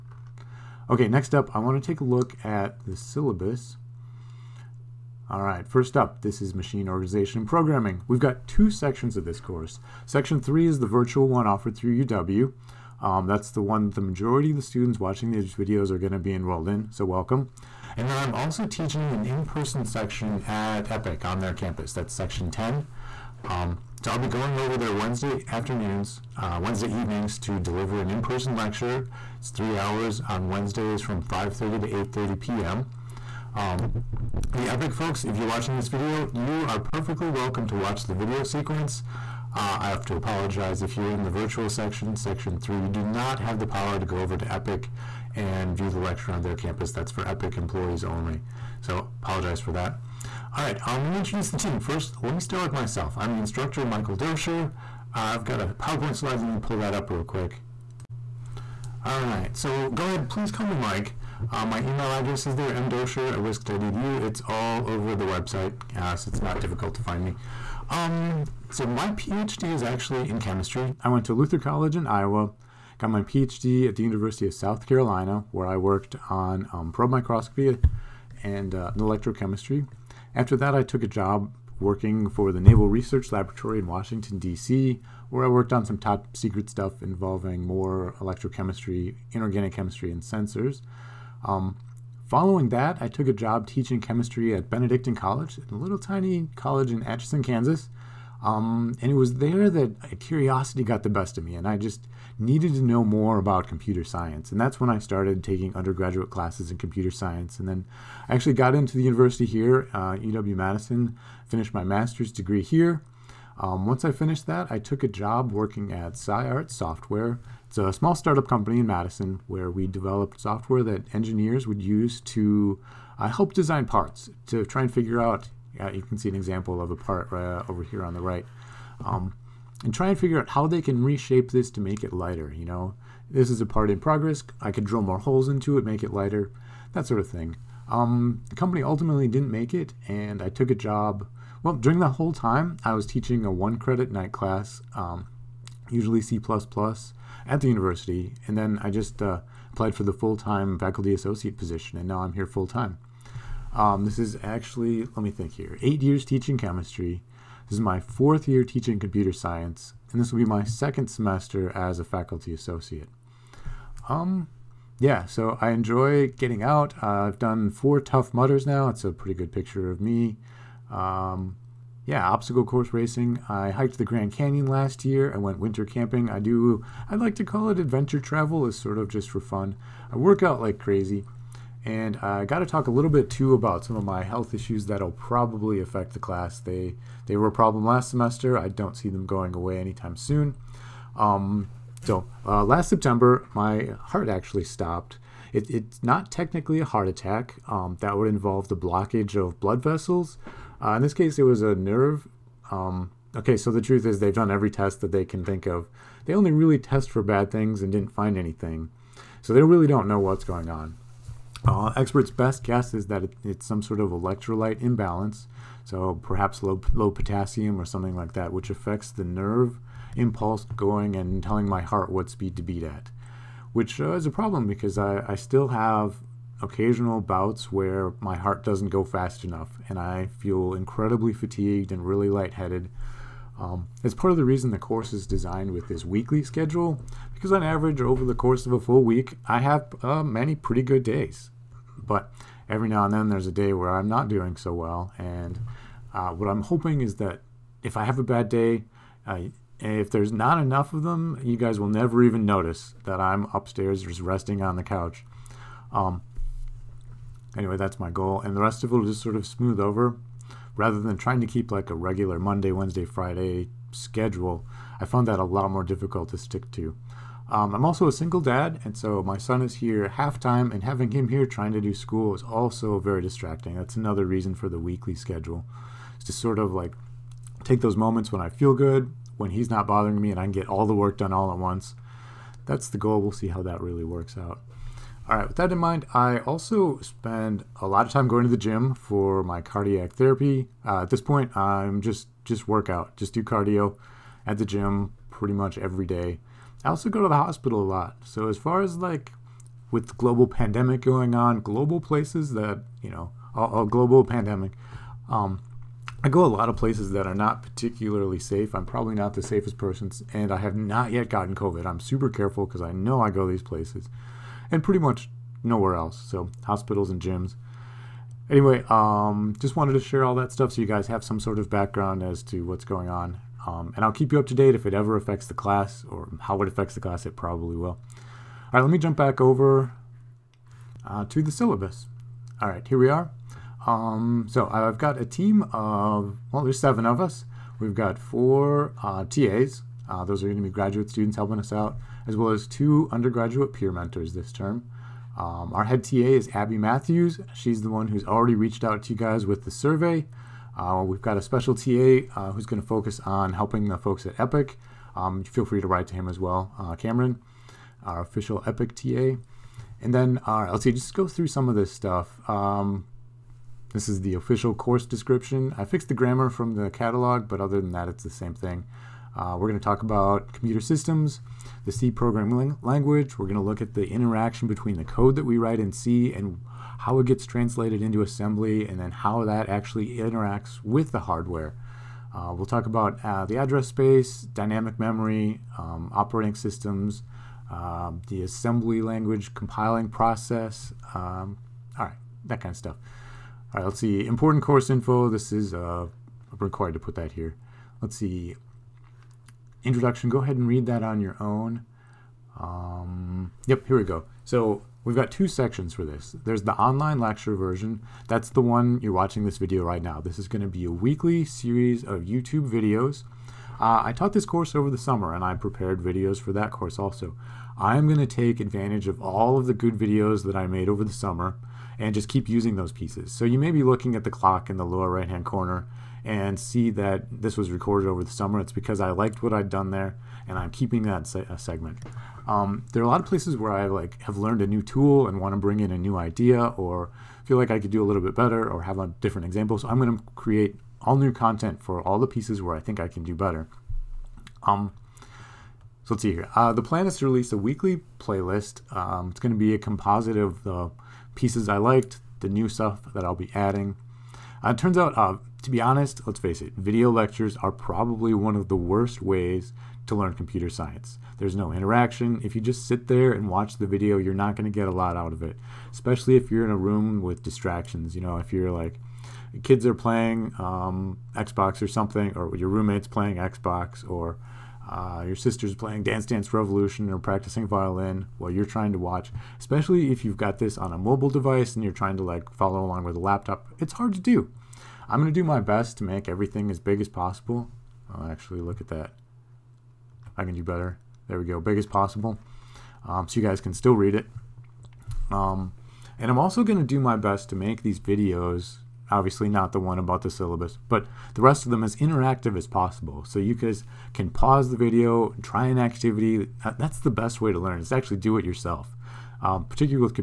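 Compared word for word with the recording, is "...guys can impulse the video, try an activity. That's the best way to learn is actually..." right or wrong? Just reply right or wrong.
wrong.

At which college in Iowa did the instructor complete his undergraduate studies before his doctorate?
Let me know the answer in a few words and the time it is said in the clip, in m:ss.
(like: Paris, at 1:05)
Luther College, at 1:11.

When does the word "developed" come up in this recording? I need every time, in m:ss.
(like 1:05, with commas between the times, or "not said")
1:59.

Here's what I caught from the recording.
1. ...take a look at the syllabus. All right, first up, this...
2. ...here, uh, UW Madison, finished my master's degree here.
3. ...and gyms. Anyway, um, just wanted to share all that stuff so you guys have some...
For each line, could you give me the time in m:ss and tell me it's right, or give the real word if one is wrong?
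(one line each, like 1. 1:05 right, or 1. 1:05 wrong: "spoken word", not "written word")
1. 0:01 right
2. 1:49 right
3. 5:17 right.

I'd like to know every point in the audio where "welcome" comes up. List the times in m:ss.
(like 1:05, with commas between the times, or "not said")
0:17, 0:37.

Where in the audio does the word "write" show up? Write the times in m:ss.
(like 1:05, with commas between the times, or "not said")
5:55, 6:15.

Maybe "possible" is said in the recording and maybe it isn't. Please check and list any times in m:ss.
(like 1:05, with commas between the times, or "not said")
8:07, 8:11, 8:22.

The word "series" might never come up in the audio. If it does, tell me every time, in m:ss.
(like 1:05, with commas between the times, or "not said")
6:51.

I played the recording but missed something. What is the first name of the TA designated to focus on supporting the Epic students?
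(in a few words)
Cameron.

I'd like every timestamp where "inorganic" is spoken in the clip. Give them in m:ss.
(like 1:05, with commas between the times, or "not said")
1:29.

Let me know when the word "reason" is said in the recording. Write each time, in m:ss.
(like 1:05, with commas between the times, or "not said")
3:54, 4:34.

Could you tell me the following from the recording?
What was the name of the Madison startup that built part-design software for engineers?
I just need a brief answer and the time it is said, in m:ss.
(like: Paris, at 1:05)
SciArt Software, at 1:56.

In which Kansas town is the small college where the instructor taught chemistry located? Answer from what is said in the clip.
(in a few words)
Atchison.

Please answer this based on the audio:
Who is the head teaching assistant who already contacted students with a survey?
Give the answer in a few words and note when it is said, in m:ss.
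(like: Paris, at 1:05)
Abby Matthews, at 5:46.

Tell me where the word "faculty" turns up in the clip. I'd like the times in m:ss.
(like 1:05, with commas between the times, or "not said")
2:30, 2:42.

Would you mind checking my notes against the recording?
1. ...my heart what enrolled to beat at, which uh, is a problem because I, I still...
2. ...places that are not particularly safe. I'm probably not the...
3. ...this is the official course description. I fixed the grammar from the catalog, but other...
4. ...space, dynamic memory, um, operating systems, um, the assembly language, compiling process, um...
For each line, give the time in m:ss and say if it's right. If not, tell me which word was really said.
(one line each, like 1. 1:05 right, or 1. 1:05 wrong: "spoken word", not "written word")
1. 3:41 wrong: "speed", not "enrolled"
2. 5:06 right
3. 6:03 right
4. 6:23 right.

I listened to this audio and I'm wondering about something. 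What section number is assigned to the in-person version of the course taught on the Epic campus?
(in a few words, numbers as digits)
10.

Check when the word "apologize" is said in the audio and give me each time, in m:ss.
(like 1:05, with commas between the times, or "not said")
0:40, 0:49.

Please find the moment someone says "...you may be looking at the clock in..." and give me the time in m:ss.
7:03.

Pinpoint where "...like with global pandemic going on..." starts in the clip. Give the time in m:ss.
4:58.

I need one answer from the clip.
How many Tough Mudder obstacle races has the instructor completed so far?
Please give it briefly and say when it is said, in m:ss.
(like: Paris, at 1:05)
4, at 2:47.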